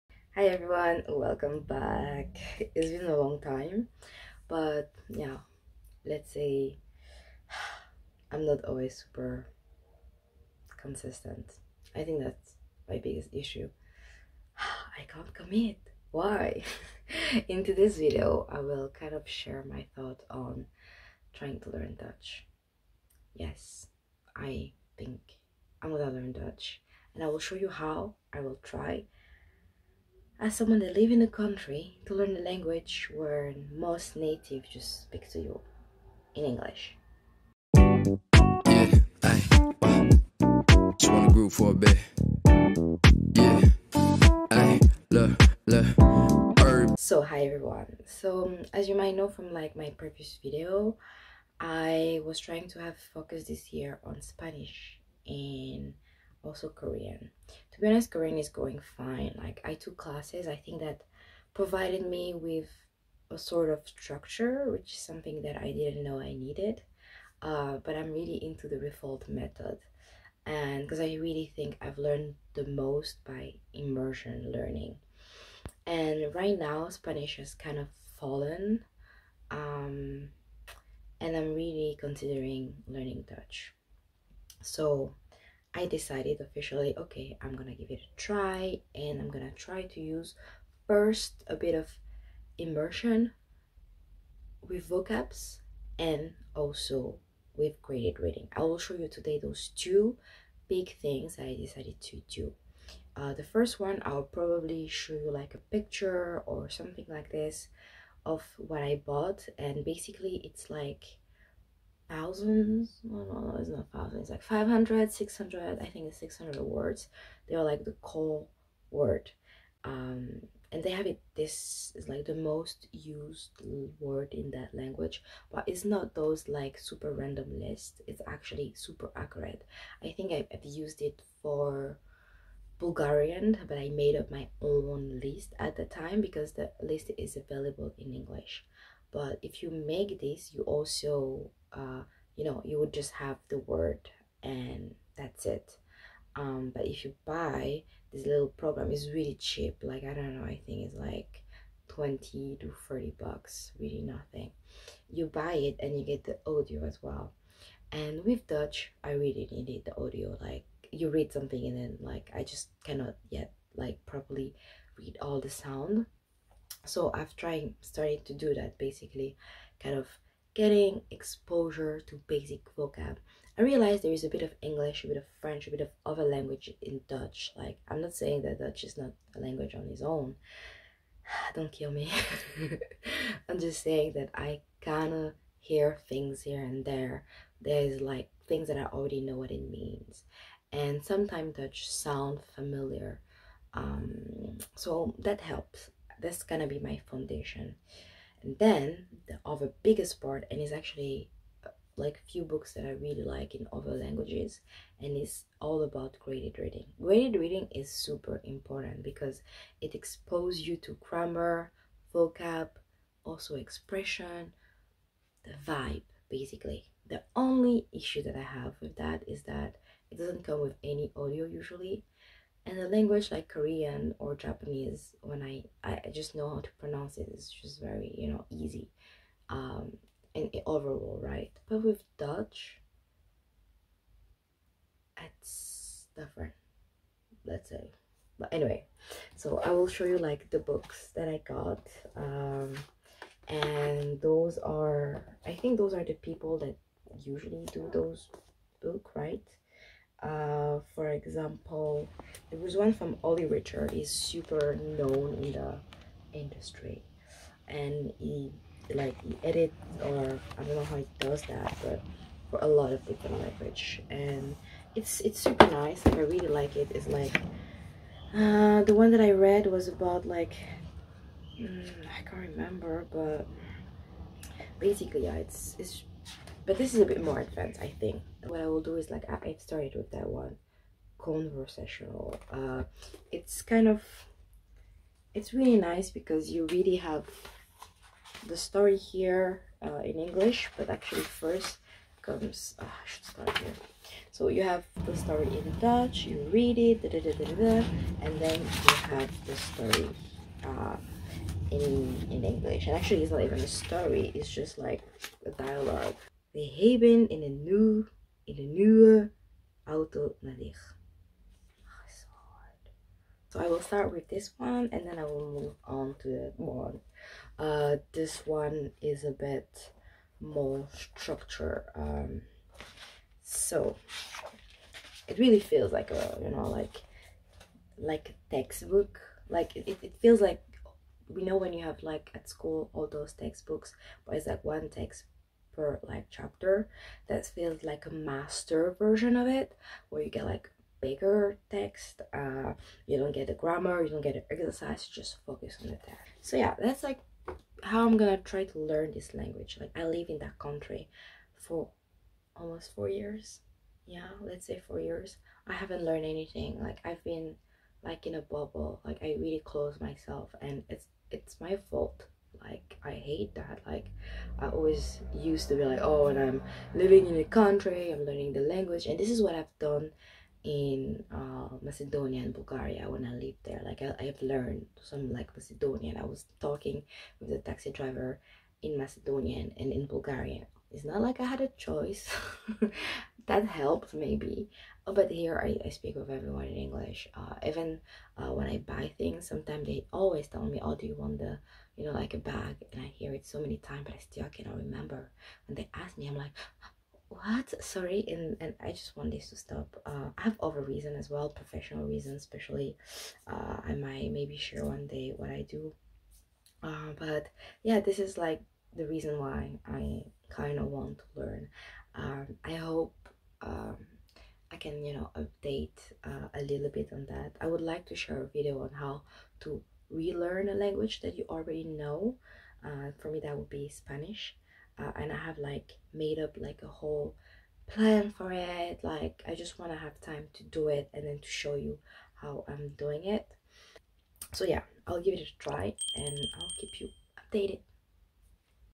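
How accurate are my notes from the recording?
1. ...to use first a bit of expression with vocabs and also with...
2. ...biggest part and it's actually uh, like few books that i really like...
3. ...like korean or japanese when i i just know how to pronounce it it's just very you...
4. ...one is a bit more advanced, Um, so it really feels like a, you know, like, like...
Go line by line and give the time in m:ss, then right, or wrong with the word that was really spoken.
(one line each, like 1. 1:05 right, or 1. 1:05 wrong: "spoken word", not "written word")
1. 1:29 wrong: "immersion", not "expression"
2. 3:19 right
3. 3:43 right
4. 5:18 wrong: "structured", not "advanced".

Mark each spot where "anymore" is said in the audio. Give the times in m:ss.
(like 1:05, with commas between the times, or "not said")
not said.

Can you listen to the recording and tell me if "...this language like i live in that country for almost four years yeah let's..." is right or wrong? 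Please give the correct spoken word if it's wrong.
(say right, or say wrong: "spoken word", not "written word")
right.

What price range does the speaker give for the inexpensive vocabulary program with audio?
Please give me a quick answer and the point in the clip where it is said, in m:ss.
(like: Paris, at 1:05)
20 to 30 bucks, at 2:31.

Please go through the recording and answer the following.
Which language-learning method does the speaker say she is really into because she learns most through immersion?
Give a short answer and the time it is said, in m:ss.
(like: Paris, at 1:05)
Refold method, at 1:08.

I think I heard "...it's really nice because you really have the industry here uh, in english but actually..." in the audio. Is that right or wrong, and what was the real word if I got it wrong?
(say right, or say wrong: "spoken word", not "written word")
wrong: "story", not "industry".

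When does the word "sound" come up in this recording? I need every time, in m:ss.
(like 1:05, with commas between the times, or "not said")
2:45, 3:11.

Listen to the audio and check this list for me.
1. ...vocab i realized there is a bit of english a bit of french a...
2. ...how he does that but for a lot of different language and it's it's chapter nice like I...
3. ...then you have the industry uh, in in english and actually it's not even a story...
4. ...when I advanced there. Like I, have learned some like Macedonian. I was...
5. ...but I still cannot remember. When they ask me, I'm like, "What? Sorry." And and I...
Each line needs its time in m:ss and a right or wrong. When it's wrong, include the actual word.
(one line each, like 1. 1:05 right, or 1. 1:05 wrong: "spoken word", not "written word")
1. 2:52 right
2. 4:20 wrong: "super", not "chapter"
3. 4:58 wrong: "story", not "industry"
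4. 6:13 wrong: "lived", not "advanced"
5. 6:34 right.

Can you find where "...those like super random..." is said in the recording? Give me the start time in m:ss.
2:06.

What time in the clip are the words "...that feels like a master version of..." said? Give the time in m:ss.
5:37.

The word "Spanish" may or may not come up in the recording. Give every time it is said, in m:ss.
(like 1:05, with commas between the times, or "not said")
0:54, 1:16, 7:03.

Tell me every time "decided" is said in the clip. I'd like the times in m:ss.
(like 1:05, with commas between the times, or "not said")
1:25, 1:41.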